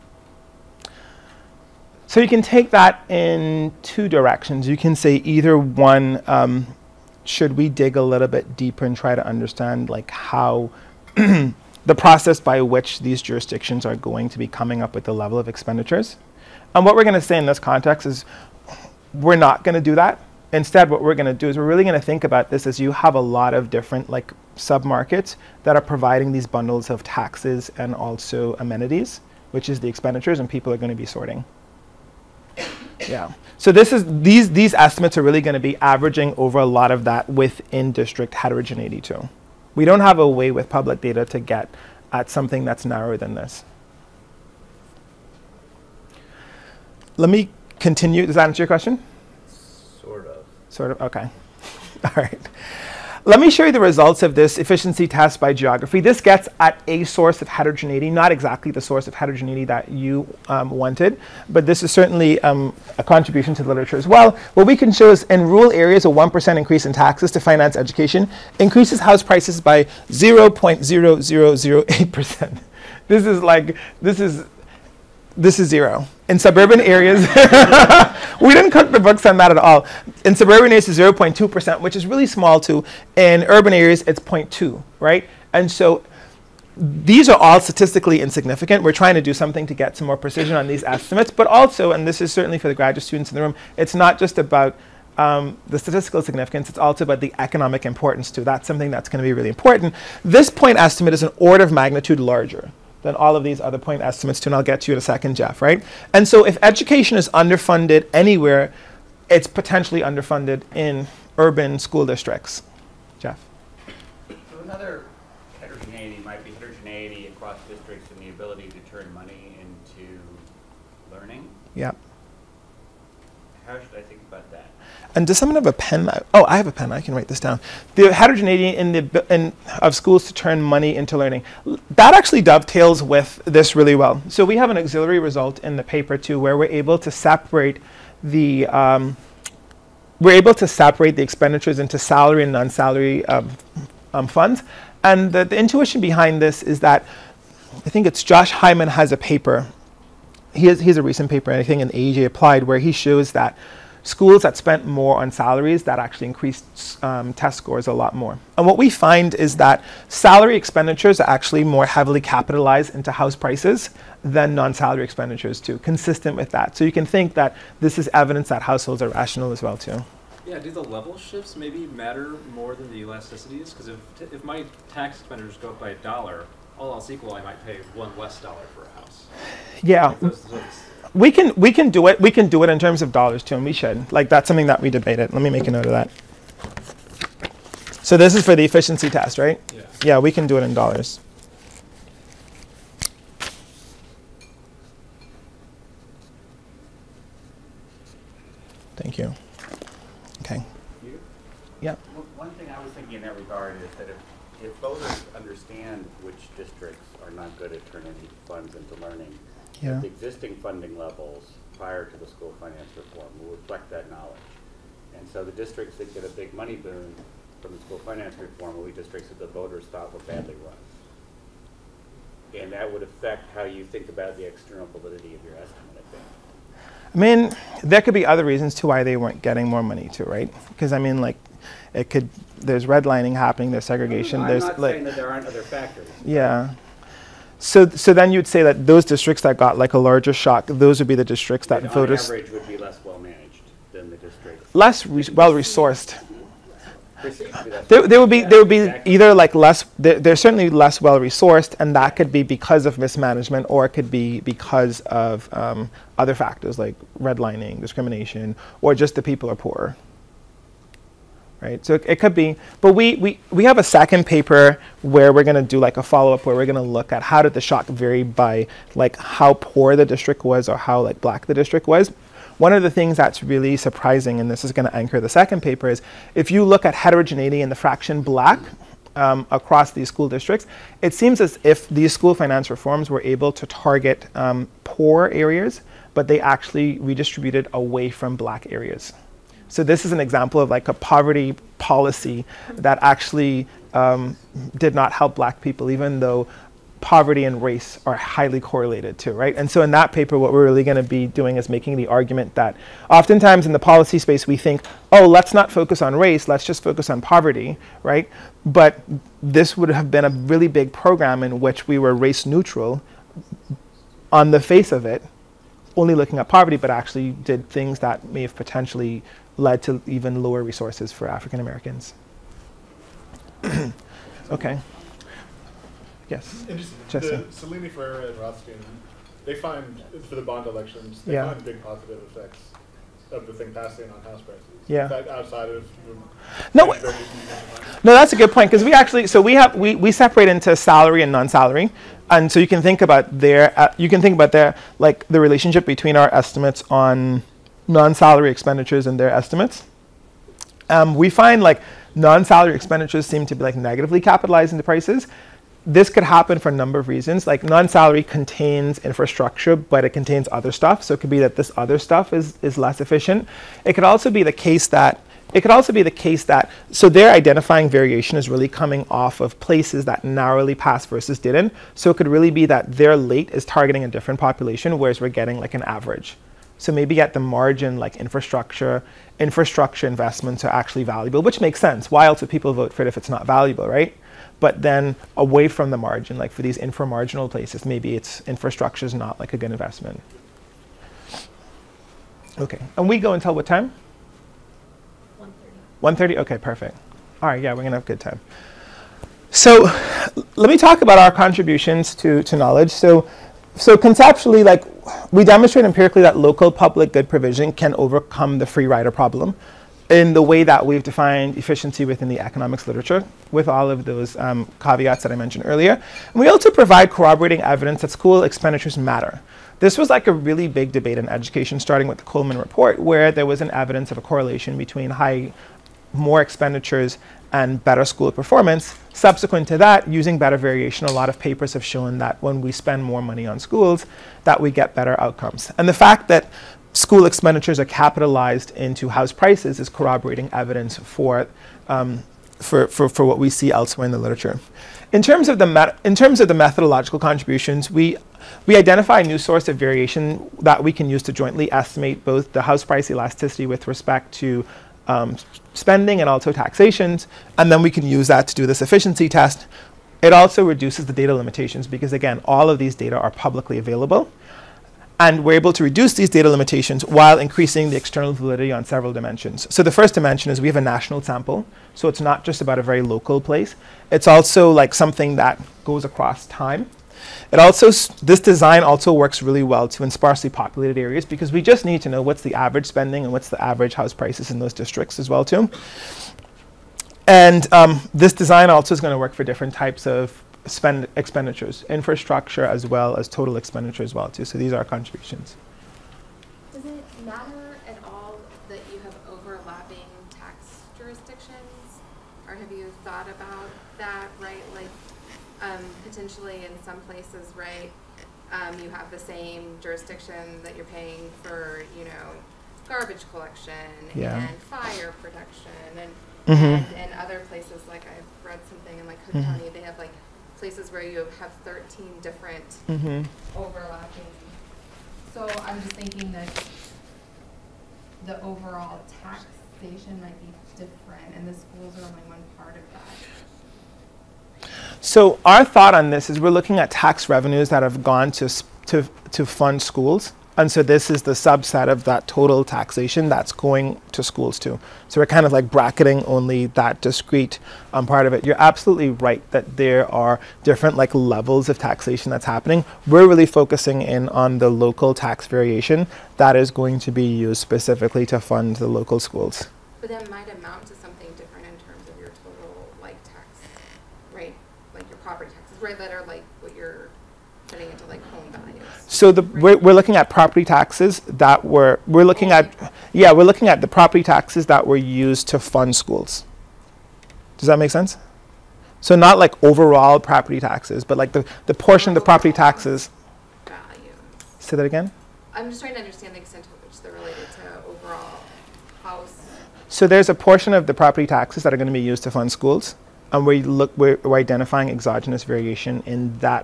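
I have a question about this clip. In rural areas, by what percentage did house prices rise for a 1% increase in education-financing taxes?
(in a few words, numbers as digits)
0.0008%.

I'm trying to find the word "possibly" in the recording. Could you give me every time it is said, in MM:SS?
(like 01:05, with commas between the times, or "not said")
not said.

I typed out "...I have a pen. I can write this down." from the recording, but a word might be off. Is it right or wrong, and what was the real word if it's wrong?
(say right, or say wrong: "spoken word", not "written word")
right.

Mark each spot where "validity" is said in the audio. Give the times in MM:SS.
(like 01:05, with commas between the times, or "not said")
03:44, 07:48.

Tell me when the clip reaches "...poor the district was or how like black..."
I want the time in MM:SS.
04:29.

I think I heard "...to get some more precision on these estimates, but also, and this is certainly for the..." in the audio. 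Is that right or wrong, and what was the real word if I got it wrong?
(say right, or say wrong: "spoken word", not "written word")
right.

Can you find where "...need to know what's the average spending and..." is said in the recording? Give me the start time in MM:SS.
08:01.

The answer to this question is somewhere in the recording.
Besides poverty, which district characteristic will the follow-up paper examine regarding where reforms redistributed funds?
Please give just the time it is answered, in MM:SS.
04:37.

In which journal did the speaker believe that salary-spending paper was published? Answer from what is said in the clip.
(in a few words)
AJ Applied.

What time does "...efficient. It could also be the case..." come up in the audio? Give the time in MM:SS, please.
06:03.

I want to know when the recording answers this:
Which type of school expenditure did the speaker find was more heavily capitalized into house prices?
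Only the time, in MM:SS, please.
02:40.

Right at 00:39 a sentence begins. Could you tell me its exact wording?
We don't have a way with public data to get at something that's narrower than this.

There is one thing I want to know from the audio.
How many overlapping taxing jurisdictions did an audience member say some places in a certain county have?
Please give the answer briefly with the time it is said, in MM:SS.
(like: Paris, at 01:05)
13, at 08:41.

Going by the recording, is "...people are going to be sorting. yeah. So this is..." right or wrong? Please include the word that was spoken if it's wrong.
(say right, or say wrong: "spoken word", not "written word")
right.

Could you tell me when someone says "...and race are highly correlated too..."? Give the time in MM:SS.
04:57.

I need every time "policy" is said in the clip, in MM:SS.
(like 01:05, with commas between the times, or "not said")
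04:51, 05:03.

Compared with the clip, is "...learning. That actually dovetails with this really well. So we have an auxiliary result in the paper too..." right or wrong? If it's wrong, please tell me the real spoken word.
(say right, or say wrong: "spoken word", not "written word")
right.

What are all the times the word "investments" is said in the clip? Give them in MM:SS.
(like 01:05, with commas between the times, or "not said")
06:20, 06:29.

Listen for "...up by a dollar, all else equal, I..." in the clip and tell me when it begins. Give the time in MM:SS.
02:55.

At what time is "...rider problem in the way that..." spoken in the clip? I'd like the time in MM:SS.
06:48.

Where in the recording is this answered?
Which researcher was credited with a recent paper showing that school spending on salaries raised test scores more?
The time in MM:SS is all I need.
02:28.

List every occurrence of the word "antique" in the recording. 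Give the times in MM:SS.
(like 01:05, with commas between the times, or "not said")
not said.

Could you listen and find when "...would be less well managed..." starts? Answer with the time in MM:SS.
04:02.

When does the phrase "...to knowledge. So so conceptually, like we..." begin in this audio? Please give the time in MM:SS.
06:42.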